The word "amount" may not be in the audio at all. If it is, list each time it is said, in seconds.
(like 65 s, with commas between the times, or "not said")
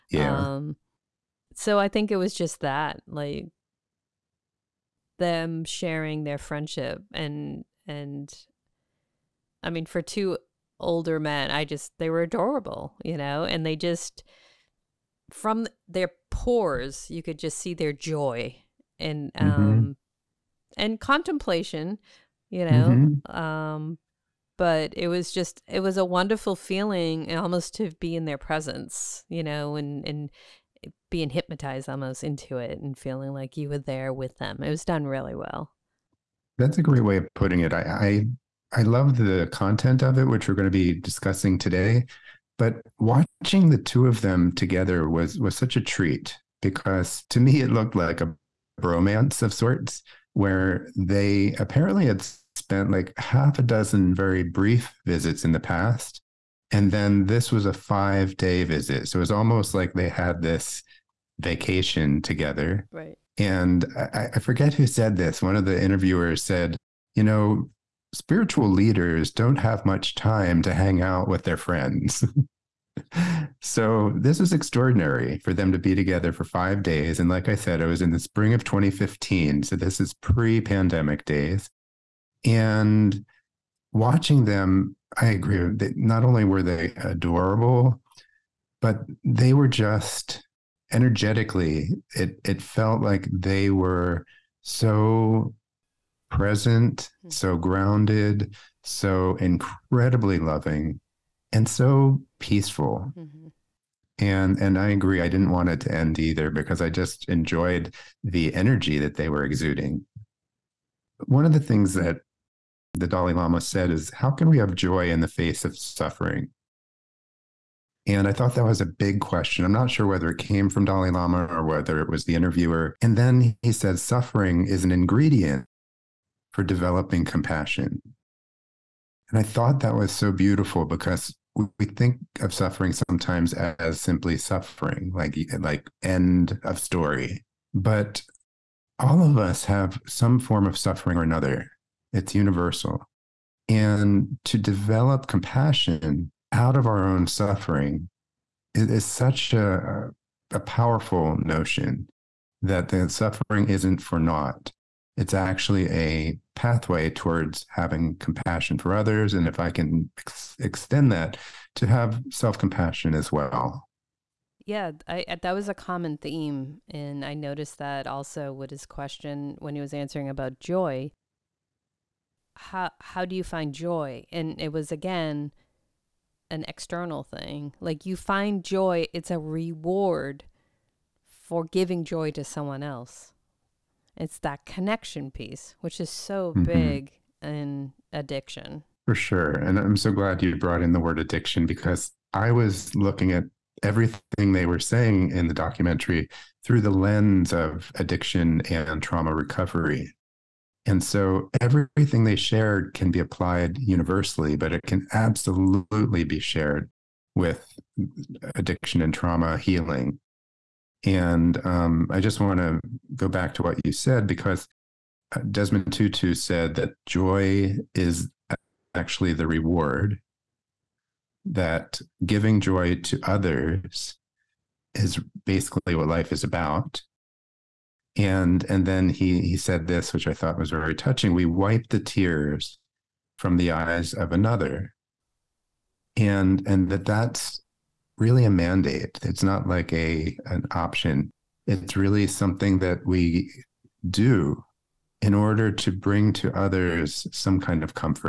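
not said.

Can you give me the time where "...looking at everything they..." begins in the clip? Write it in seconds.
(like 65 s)
192 s.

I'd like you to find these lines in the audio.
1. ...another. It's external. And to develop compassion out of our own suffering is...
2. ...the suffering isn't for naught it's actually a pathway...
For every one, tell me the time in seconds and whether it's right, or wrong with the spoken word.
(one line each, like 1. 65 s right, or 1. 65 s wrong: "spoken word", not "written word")
1. 141 s wrong: "universal", not "external"
2. 152 s right.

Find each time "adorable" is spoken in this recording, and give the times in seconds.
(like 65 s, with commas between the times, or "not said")
12 s, 86 s.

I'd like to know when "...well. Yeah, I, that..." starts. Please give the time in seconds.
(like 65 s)
163 s.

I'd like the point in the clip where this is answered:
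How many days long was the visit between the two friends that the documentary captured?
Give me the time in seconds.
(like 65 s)
57 s.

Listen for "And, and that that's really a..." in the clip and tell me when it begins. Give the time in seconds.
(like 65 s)
236 s.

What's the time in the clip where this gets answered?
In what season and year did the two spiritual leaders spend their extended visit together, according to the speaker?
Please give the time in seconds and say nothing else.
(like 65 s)
78 s.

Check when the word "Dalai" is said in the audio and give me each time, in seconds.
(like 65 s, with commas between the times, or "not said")
113 s, 120 s.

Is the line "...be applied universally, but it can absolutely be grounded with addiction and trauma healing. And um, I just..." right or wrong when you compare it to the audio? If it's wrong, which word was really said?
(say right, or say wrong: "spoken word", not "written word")
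wrong: "shared", not "grounded".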